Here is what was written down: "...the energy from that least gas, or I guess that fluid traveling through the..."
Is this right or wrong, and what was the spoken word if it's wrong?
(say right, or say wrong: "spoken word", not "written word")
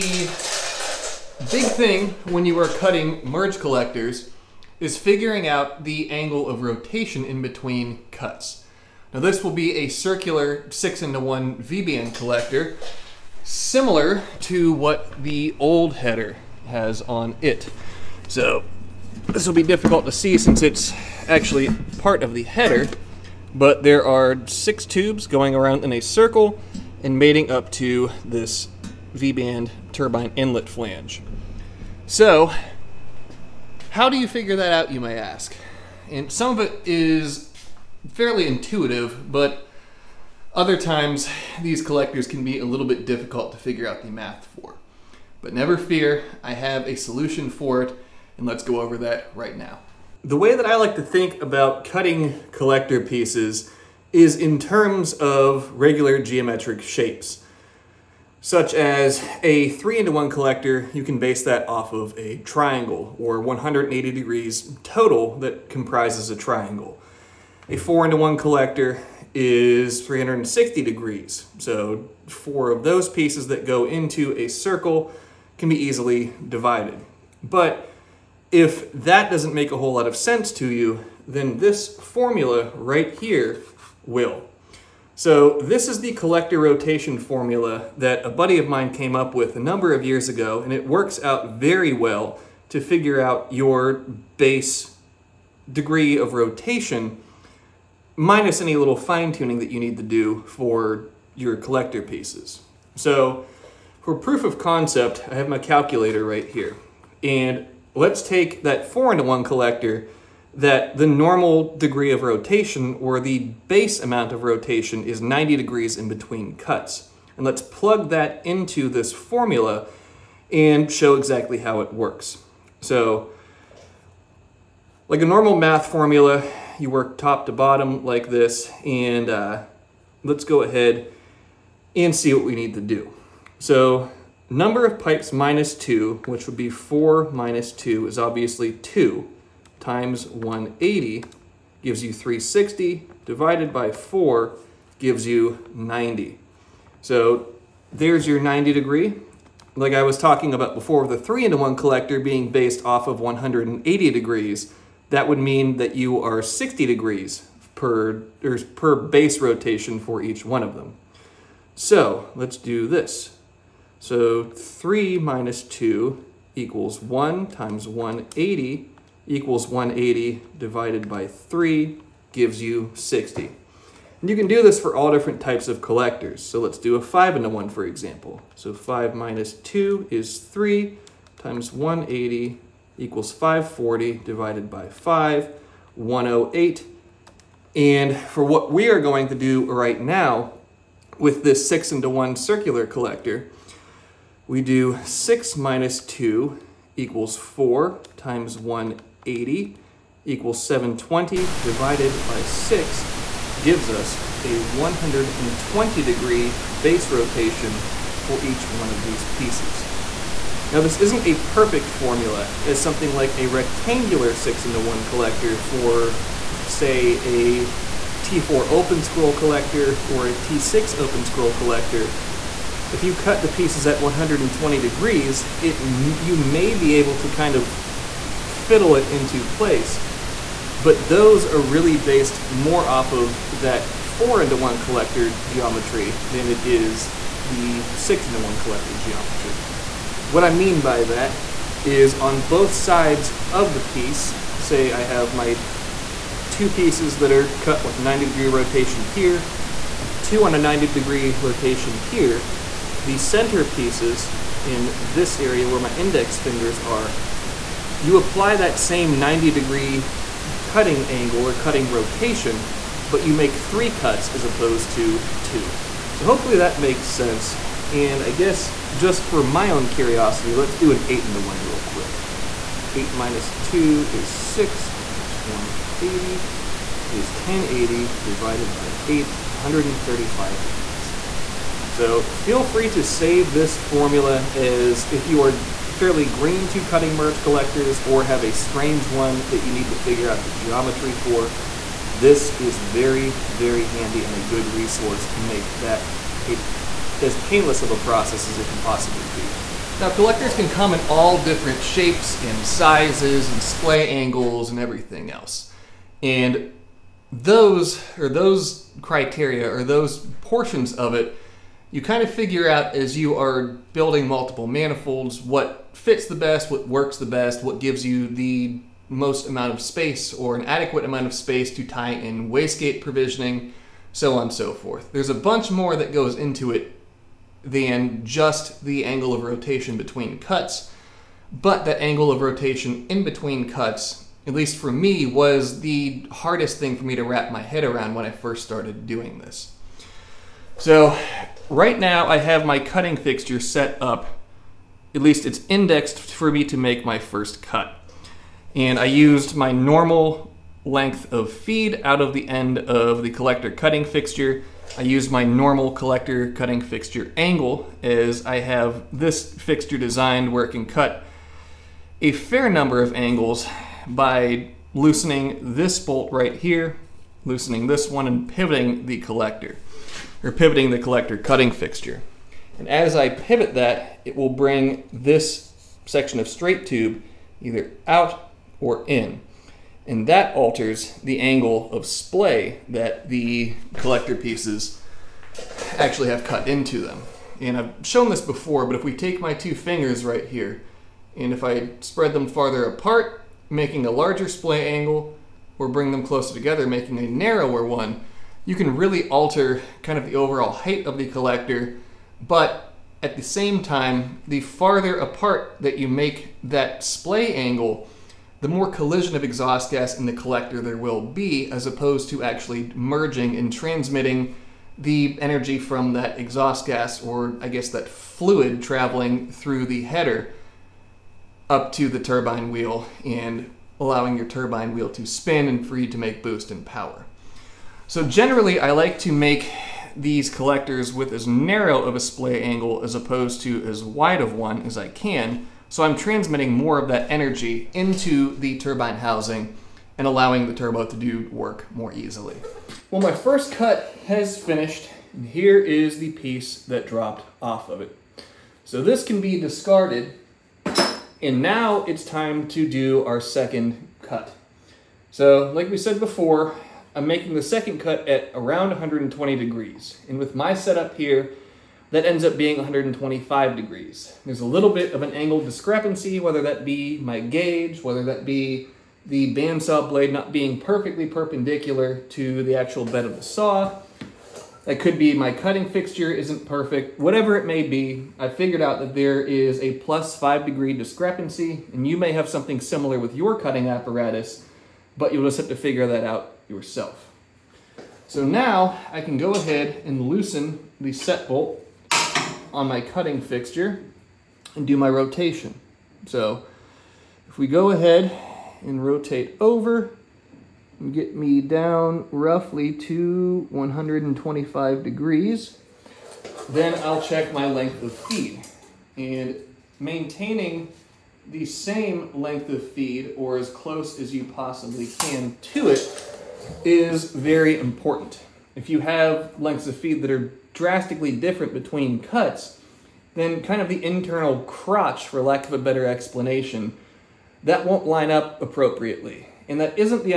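wrong: "exhaust", not "least".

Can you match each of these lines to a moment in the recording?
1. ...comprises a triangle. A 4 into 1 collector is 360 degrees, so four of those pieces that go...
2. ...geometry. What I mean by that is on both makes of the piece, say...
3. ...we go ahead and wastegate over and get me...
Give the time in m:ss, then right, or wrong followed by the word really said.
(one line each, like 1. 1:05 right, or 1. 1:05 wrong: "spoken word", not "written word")
1. 1:05 right
2. 3:58 wrong: "sides", not "makes"
3. 8:17 wrong: "rotate", not "wastegate".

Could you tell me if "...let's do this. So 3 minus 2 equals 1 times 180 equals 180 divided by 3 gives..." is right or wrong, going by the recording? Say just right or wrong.
right.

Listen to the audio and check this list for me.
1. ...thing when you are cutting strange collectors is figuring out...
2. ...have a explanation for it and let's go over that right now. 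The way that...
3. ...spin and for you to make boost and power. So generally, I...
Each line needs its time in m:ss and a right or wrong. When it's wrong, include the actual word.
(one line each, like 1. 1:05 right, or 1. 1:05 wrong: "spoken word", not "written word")
1. 0:01 wrong: "merge", not "strange"
2. 0:46 wrong: "solution", not "explanation"
3. 7:05 right.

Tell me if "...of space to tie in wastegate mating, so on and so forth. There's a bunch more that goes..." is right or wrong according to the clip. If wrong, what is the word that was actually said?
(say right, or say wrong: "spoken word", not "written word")
wrong: "provisioning", not "mating".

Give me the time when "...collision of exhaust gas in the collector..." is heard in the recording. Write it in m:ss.
6:48.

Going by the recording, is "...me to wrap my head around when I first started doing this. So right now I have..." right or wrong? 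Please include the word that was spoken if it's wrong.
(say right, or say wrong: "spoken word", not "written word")
right.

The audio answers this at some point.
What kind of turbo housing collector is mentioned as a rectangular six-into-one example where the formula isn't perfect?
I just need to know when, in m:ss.
3:38.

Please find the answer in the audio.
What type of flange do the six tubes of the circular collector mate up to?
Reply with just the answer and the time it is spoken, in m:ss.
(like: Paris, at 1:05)
V-band turbine inlet flange, at 0:29.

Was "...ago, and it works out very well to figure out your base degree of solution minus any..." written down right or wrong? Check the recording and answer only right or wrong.
wrong.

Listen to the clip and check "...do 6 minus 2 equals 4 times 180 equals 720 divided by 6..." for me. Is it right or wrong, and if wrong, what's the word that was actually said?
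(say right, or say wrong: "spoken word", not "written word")
right.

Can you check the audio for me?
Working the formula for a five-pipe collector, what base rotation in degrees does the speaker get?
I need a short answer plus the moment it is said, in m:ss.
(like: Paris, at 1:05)
108, at 3:05.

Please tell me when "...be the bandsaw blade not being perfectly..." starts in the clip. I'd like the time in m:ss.
7:48.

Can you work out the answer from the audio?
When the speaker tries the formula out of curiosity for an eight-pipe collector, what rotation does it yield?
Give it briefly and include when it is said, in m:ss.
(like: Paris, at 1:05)
135 degrees, at 4:39.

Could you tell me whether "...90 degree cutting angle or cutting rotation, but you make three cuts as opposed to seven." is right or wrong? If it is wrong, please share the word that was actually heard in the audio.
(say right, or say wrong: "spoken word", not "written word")
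wrong: "two", not "seven".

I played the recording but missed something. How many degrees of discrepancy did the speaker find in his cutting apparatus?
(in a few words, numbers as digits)
Plus 5 degrees.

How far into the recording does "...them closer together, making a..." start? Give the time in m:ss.
6:36.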